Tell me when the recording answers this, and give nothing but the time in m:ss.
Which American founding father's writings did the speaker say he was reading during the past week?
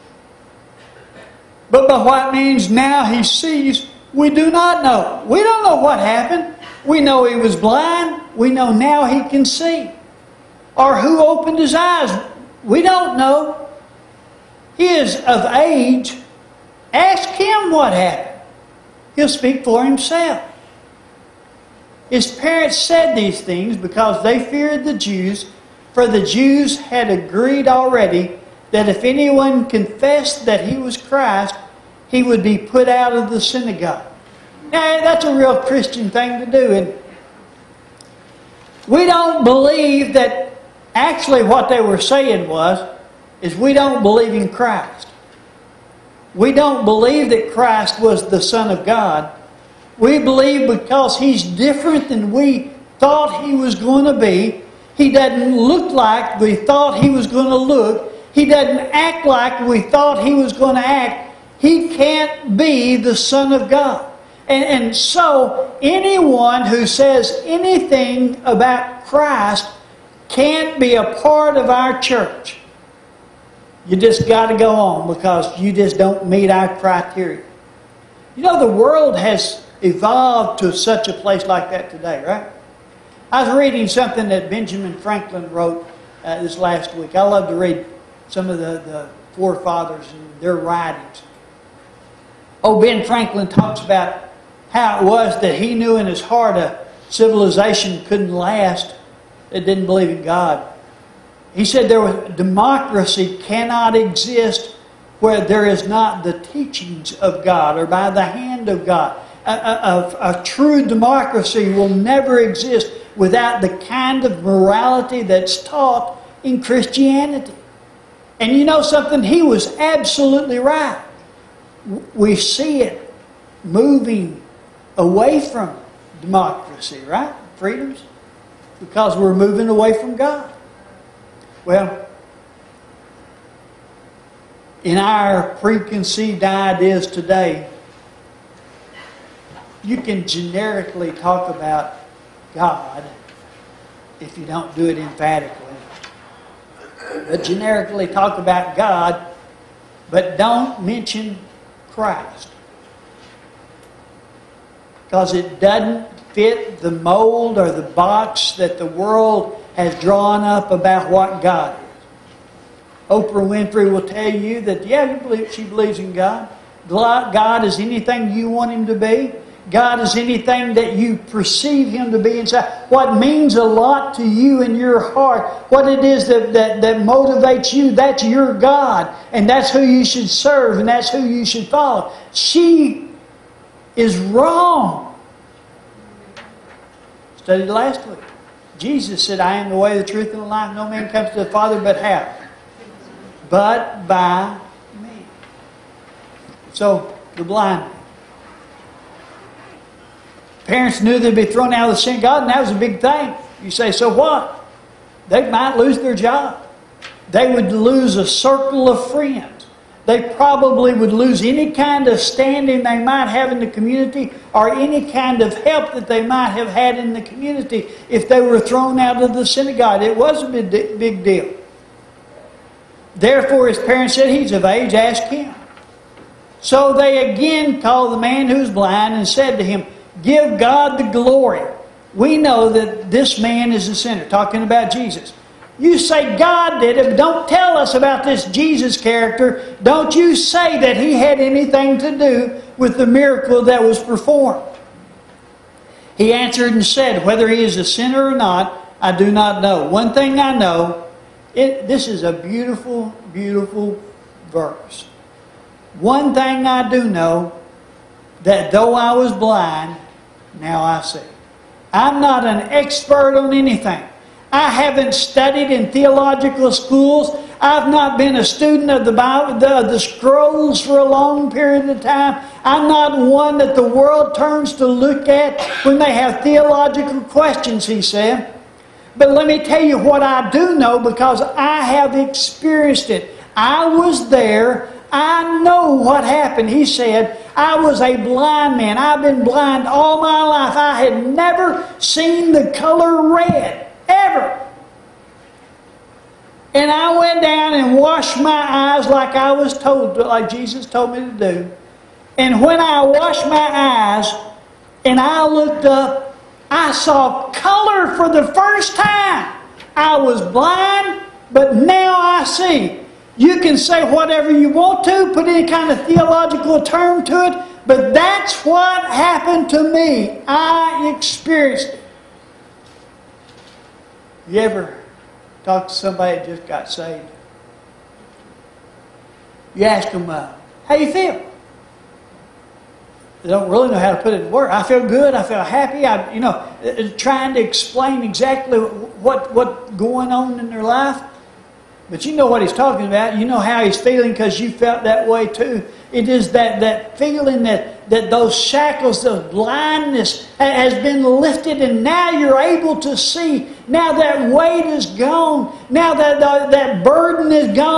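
1:24.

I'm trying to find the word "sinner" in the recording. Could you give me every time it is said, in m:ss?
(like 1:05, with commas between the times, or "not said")
3:53, 4:07.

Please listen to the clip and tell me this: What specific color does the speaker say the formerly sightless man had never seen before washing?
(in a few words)
Red.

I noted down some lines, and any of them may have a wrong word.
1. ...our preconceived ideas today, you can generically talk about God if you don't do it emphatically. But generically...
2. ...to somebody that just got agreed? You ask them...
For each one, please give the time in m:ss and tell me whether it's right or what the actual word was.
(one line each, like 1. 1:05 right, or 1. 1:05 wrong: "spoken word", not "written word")
1. 2:14 right
2. 5:25 wrong: "saved", not "agreed".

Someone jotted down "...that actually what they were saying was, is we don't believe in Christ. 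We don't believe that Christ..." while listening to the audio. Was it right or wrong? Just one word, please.
right.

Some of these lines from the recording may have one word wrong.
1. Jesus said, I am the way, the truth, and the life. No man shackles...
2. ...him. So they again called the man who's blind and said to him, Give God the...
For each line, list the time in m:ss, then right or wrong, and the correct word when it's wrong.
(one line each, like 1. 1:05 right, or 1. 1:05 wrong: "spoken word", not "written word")
1. 3:08 wrong: "comes", not "shackles"
2. 3:45 right.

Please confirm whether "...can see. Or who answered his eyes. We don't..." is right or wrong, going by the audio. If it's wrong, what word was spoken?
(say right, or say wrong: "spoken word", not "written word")
wrong: "opened", not "answered".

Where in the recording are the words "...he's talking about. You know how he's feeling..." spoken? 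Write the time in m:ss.
5:42.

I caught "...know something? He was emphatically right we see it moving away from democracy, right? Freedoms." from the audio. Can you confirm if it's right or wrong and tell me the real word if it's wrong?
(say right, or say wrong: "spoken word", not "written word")
wrong: "absolutely", not "emphatically".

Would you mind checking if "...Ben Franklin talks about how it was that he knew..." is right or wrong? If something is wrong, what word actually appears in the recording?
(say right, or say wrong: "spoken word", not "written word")
right.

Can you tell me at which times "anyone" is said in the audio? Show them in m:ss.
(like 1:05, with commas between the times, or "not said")
0:29, 1:05.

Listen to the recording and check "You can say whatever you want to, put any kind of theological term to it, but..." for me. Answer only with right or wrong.
right.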